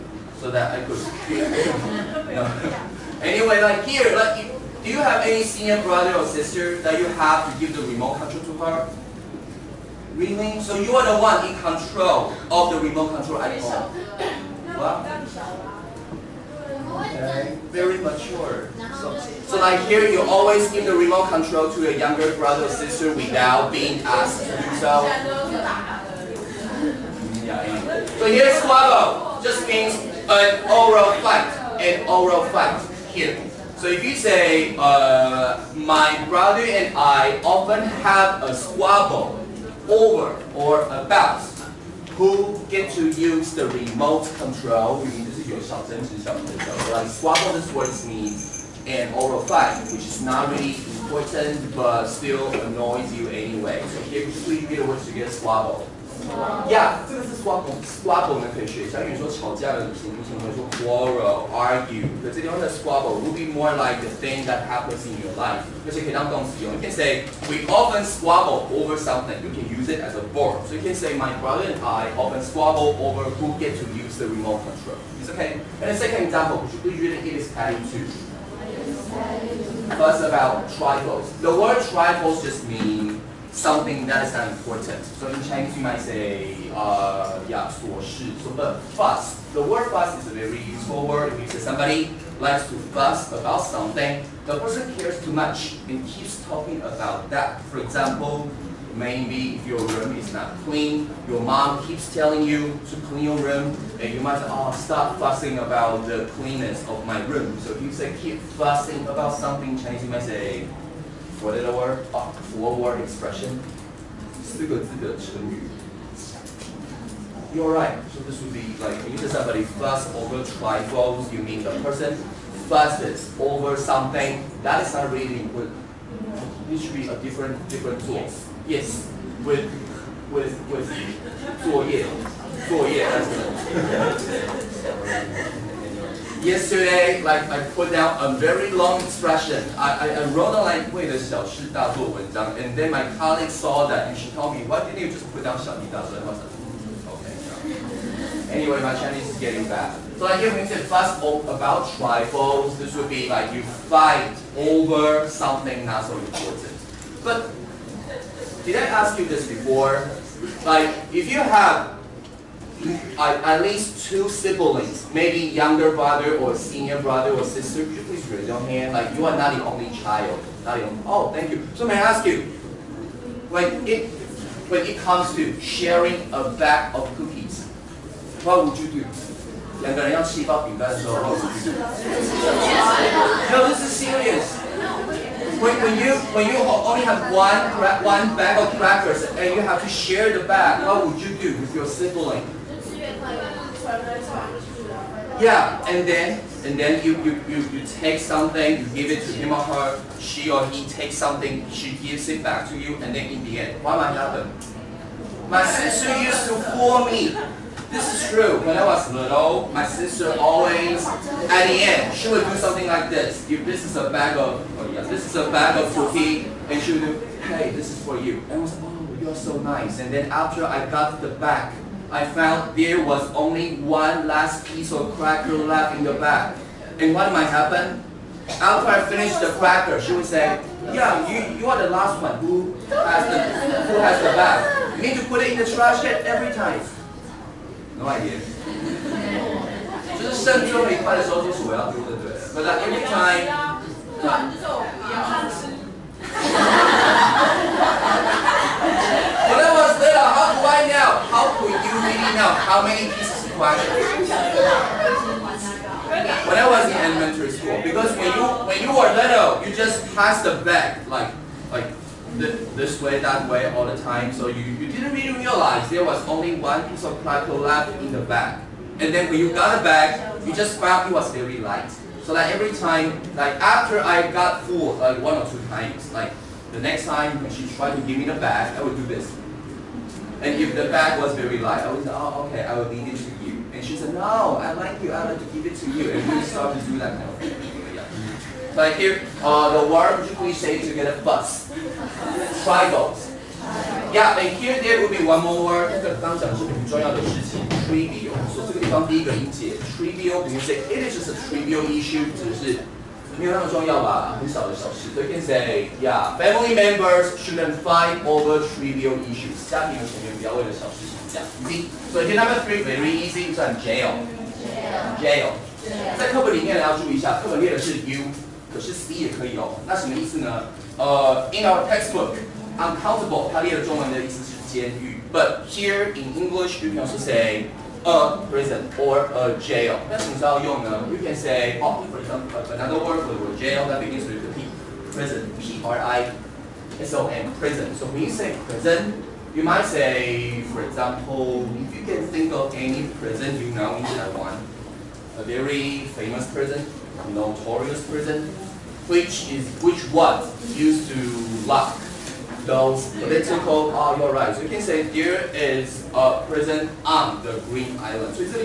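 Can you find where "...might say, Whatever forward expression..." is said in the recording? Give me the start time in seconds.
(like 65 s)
110 s.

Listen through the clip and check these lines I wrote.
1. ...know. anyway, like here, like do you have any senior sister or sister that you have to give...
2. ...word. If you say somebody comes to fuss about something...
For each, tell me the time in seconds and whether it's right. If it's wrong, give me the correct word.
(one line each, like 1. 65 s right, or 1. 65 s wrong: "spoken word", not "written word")
1. 2 s wrong: "brother", not "sister"
2. 91 s wrong: "likes", not "comes".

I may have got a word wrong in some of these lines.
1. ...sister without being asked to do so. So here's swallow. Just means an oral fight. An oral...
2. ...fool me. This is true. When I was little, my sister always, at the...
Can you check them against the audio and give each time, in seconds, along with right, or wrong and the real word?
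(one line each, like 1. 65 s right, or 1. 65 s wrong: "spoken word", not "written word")
1. 22 s right
2. 206 s right.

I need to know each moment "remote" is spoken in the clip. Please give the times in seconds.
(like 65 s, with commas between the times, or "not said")
7 s, 12 s, 20 s, 43 s, 74 s.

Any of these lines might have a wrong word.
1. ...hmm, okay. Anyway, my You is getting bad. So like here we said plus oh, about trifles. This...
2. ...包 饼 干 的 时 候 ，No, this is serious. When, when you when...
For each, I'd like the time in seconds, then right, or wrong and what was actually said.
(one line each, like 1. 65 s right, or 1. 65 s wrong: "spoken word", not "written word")
1. 146 s wrong: "Chinese", not "You"
2. 180 s right.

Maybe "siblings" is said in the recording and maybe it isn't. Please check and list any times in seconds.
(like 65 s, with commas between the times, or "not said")
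164 s, 191 s.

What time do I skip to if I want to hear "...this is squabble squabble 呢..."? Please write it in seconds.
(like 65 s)
56 s.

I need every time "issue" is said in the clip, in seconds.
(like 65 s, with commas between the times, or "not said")
301 s, 309 s.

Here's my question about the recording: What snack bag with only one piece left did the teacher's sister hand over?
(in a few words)
cookies.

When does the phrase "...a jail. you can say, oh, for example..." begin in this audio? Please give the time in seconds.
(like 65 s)
329 s.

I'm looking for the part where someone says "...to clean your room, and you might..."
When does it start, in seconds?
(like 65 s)
102 s.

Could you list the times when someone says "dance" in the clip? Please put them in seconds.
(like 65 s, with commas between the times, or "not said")
not said.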